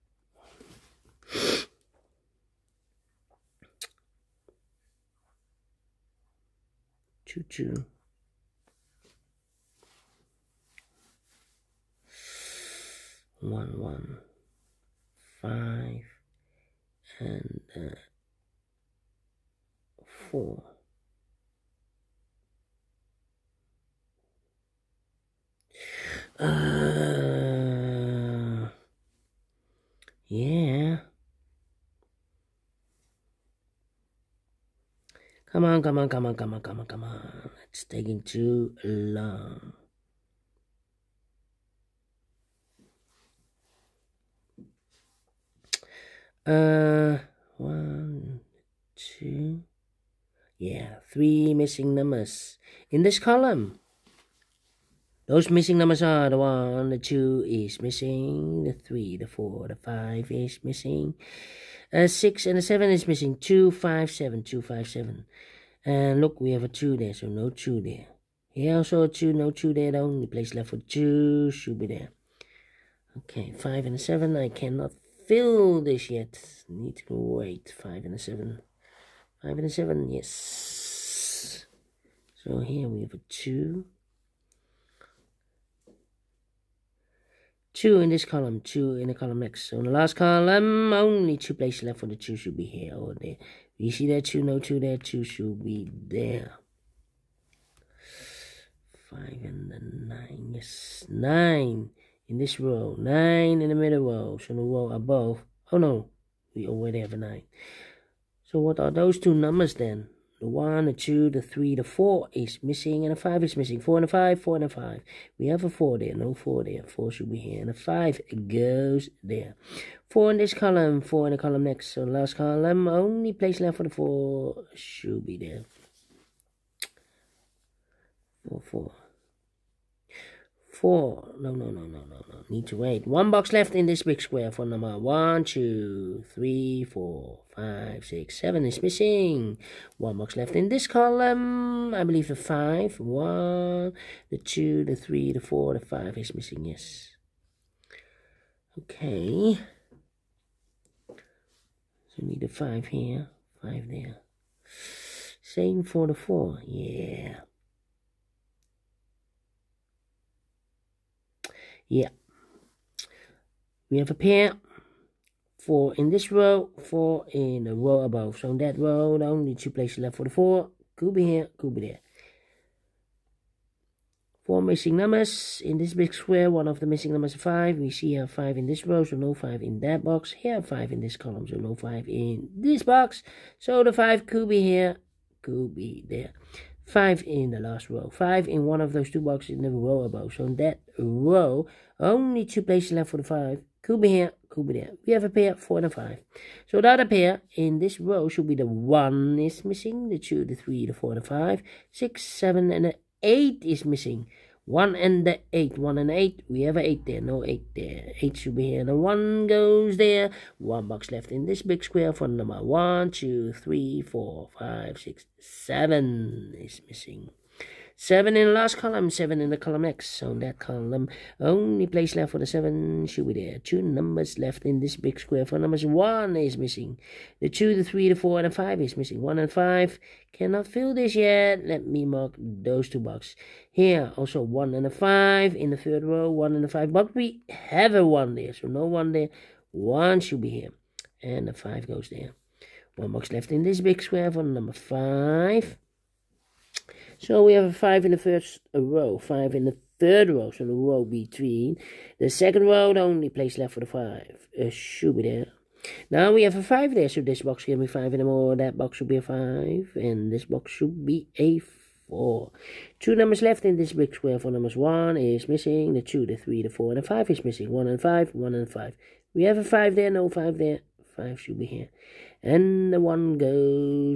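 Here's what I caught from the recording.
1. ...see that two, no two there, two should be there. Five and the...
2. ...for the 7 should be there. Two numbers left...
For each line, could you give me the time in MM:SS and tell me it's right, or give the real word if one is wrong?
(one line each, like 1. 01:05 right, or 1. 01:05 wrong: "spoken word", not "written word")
1. 01:33 right
2. 03:42 right.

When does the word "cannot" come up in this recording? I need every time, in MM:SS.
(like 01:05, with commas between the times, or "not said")
01:14, 03:50.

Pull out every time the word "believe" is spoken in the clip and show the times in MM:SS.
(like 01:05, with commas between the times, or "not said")
02:22.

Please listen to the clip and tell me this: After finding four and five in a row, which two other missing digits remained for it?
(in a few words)
1 and 8.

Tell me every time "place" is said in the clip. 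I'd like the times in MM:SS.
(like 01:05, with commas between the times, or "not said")
01:10, 01:31, 02:03, 02:49, 03:12, 03:41, 04:13.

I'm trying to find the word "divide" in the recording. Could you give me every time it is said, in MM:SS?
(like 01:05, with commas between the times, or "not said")
not said.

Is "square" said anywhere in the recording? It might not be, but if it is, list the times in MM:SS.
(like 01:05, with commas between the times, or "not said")
02:14, 02:56, 03:31, 03:45, 04:04, 04:24.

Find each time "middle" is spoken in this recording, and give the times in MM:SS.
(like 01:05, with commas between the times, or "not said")
01:43.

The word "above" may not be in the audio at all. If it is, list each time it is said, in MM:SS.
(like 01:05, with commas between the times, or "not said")
01:44, 02:48, 03:10.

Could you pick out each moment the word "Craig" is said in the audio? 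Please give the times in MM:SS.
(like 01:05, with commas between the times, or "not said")
not said.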